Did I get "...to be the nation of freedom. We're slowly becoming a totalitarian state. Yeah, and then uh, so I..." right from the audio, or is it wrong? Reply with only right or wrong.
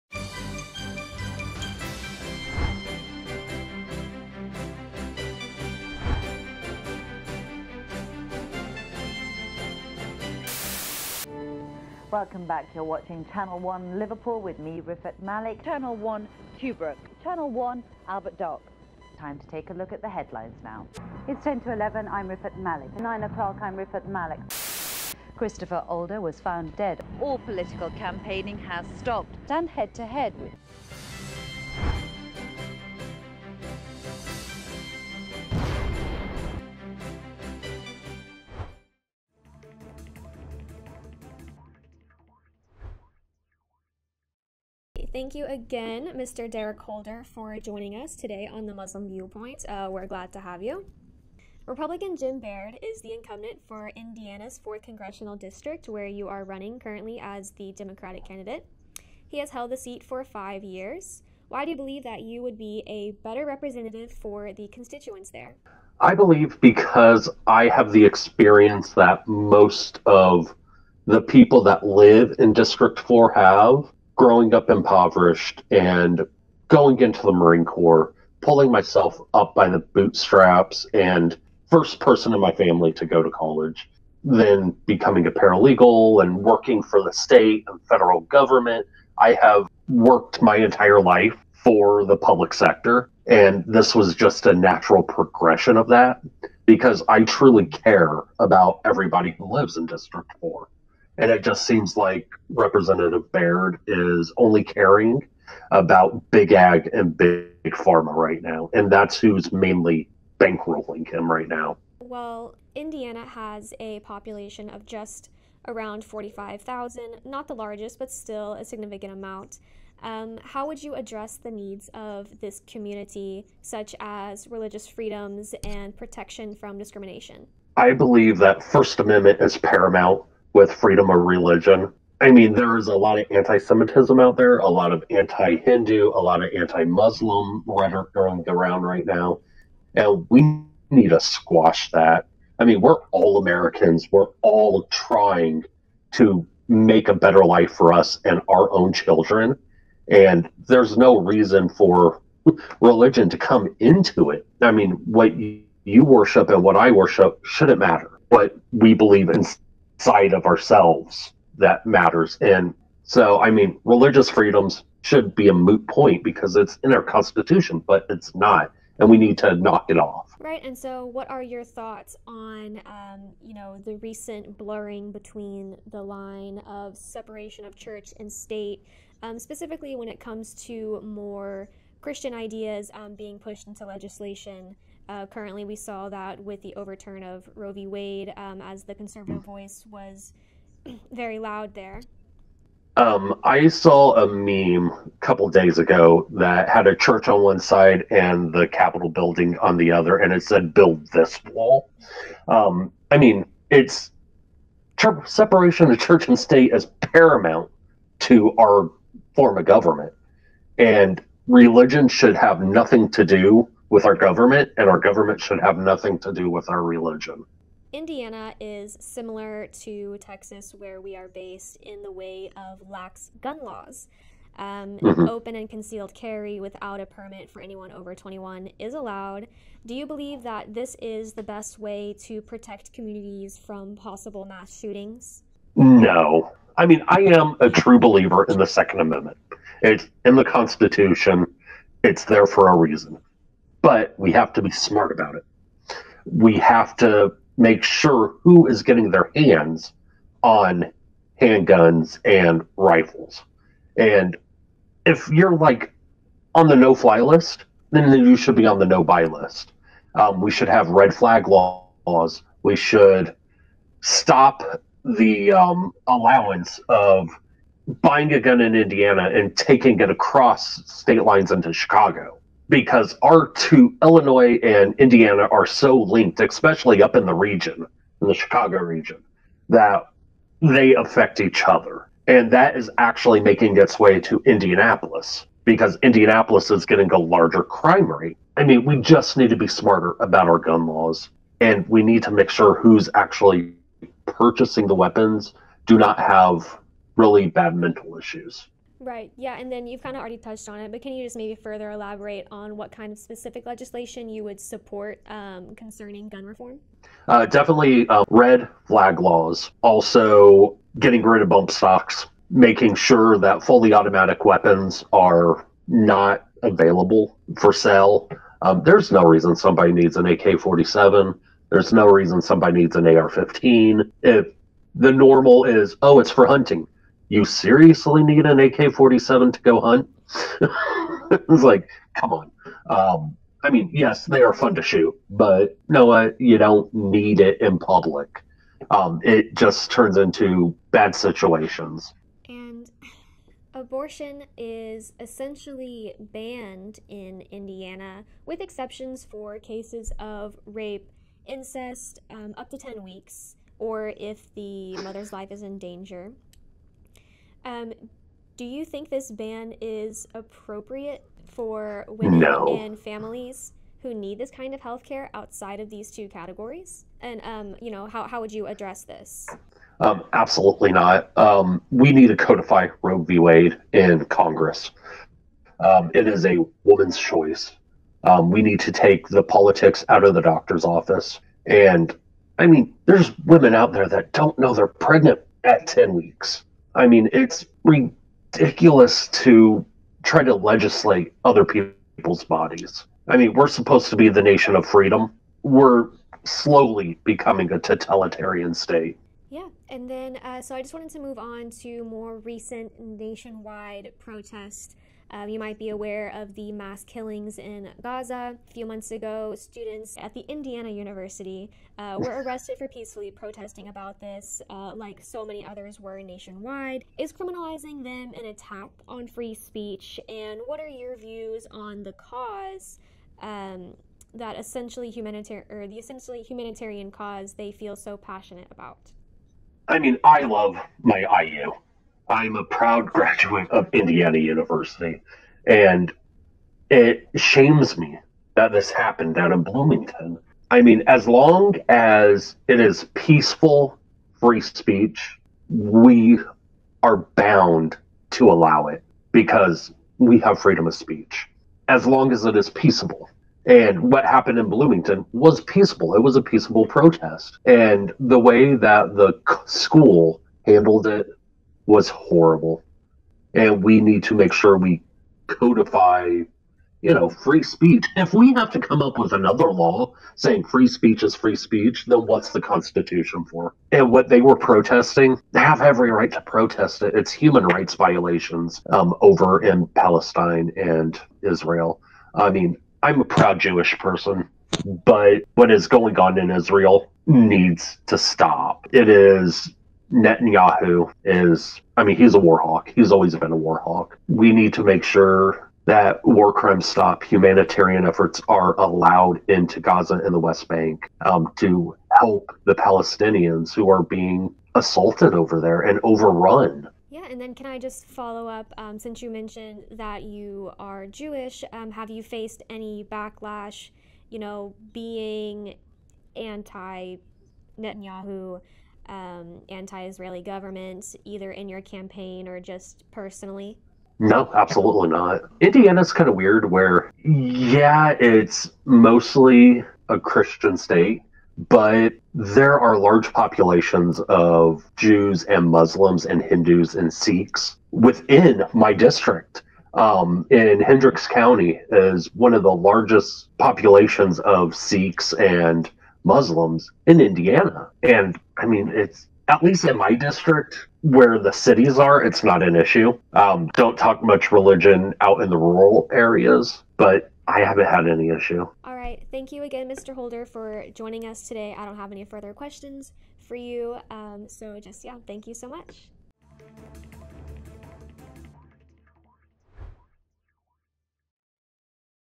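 right.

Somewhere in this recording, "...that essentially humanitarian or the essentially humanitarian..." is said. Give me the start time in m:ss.
7:04.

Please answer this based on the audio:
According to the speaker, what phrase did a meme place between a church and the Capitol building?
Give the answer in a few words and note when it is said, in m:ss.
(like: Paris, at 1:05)
Build this wall, at 3:20.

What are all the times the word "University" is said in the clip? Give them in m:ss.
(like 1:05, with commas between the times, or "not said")
6:50, 7:14.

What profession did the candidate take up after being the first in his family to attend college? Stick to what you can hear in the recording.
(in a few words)
Paralegal.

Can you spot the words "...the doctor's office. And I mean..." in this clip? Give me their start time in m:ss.
6:20.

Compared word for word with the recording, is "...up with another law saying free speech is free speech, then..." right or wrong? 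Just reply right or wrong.
right.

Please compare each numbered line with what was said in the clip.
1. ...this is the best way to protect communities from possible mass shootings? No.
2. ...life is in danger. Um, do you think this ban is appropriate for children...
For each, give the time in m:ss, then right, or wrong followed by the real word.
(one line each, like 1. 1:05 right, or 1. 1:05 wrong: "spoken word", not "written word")
1. 3:50 right
2. 5:55 wrong: "women", not "children".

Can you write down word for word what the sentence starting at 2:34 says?
I mean, what you worship and what I worship shouldn't matter.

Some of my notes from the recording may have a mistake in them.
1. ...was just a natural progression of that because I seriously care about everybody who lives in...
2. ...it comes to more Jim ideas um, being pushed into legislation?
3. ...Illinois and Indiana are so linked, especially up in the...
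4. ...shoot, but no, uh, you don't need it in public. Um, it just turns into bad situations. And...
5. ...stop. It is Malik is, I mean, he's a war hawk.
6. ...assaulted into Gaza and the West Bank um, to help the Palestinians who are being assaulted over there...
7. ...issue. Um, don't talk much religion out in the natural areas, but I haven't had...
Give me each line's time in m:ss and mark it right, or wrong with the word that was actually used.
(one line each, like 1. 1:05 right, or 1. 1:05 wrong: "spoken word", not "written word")
1. 1:33 wrong: "truly", not "seriously"
2. 3:00 wrong: "Christian", not "Jim"
3. 4:34 right
4. 5:34 right
5. 8:08 wrong: "Netanyahu", not "Malik"
6. 8:18 wrong: "allowed", not "assaulted"
7. 9:12 wrong: "rural", not "natural".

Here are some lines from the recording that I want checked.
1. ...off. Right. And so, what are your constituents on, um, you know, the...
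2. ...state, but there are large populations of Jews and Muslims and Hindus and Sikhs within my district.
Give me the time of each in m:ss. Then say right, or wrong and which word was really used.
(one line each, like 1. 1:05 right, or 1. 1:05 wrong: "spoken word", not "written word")
1. 2:49 wrong: "thoughts", not "constituents"
2. 8:50 right.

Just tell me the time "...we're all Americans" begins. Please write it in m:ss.
2:22.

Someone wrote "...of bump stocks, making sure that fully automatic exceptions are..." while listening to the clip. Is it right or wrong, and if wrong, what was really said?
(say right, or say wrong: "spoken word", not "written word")
wrong: "weapons", not "exceptions".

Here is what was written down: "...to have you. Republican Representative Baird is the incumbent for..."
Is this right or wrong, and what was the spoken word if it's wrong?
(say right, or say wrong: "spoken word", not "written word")
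wrong: "Jim", not "Representative".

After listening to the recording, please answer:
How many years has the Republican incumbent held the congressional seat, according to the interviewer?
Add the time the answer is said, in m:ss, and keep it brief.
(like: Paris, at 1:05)
5, at 1:00.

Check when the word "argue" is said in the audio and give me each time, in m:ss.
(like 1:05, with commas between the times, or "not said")
not said.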